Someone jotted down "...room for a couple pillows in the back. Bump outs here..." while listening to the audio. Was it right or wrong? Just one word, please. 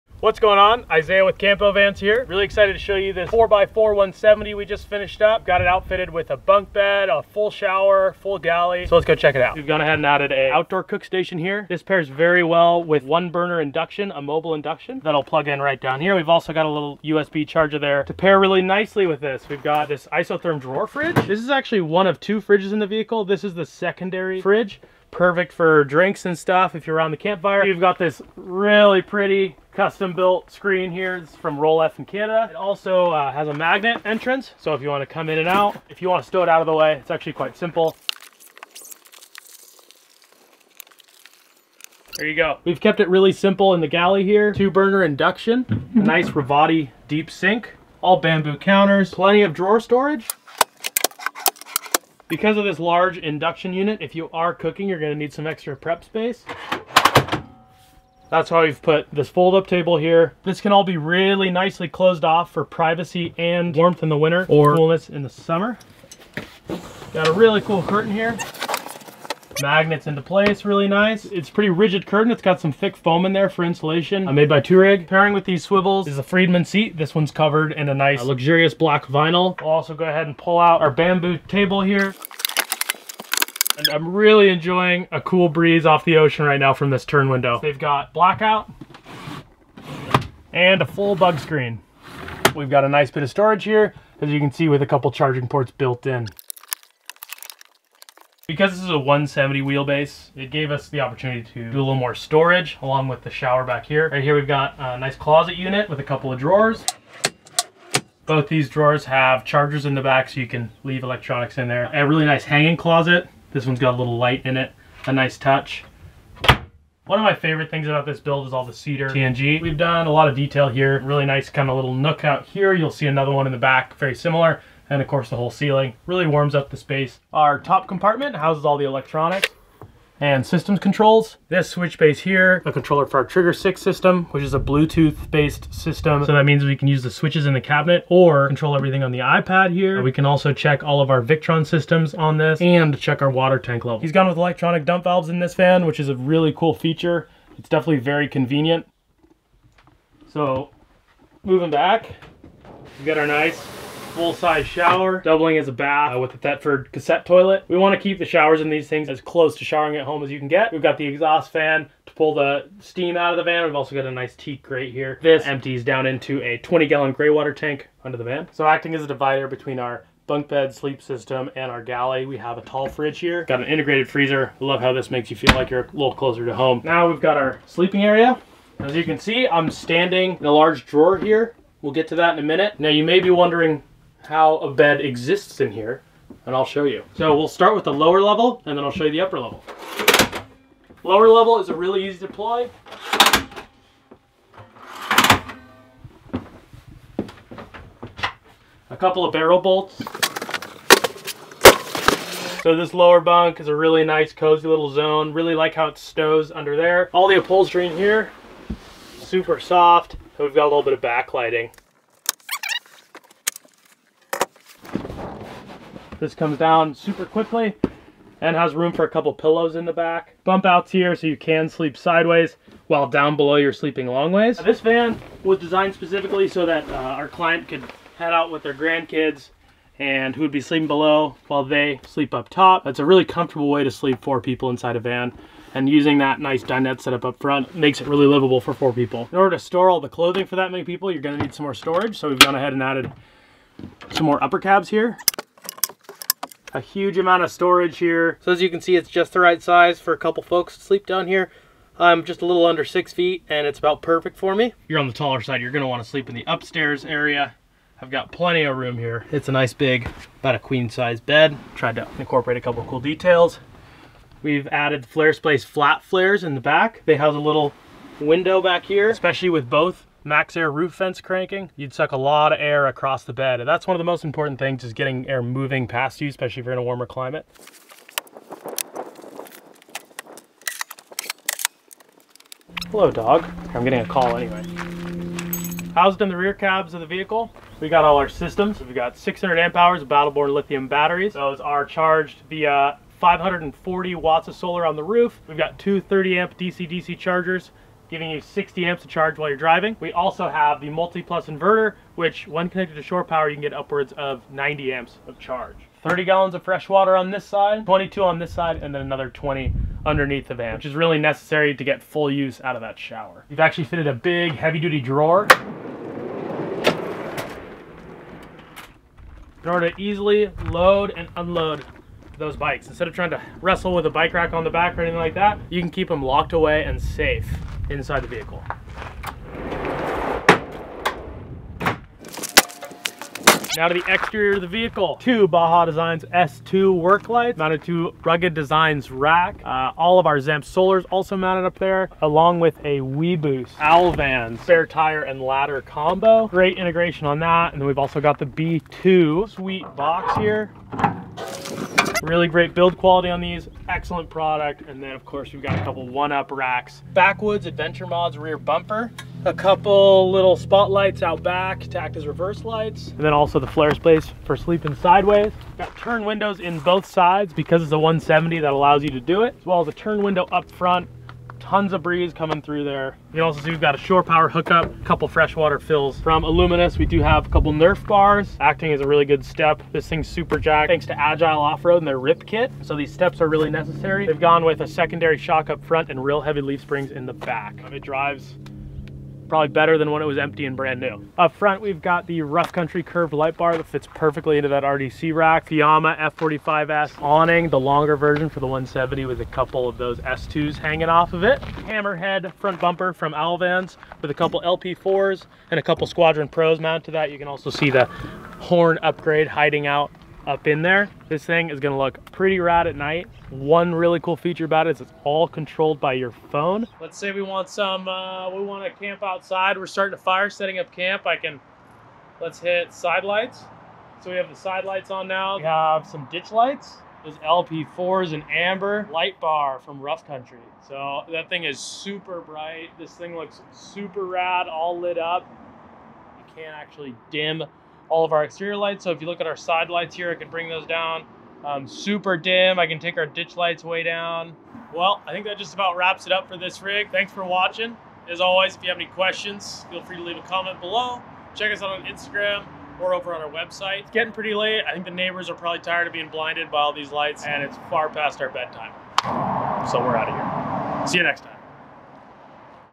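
right.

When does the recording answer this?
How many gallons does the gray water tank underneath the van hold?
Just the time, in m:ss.
2:46.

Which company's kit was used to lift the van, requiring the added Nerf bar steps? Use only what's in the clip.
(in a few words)
Agile Off-Road.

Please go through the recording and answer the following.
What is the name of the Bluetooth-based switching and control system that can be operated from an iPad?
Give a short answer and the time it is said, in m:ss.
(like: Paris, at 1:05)
Trigger 6, at 2:13.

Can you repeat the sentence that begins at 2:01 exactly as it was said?
Really nice kind of little nook out here.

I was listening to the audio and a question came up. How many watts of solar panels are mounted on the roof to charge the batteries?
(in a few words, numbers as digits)
540.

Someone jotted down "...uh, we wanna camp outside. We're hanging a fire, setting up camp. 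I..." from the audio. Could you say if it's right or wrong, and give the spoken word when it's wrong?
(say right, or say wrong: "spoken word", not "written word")
wrong: "starting", not "hanging".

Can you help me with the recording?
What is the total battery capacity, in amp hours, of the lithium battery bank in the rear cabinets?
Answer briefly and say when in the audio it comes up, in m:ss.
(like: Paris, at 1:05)
600, at 4:49.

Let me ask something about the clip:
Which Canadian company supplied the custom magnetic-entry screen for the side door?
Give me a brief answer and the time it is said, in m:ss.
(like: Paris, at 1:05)
Roll, at 0:31.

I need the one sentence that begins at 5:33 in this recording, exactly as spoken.
Now to the exterior of the vehicle.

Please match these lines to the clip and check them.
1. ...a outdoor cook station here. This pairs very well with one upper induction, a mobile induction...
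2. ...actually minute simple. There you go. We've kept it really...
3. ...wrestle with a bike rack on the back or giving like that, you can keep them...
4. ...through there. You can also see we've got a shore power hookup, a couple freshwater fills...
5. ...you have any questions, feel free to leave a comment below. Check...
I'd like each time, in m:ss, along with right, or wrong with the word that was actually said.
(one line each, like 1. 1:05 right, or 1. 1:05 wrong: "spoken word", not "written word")
1. 0:10 wrong: "burner", not "upper"
2. 0:37 wrong: "quite", not "minute"
3. 5:23 wrong: "anything", not "giving"
4. 6:12 right
5. 7:28 right.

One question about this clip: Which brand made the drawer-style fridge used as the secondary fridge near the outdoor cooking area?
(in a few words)
Isotherm.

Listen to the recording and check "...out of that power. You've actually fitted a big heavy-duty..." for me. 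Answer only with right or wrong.
wrong.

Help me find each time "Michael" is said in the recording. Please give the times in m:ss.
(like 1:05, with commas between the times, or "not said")
not said.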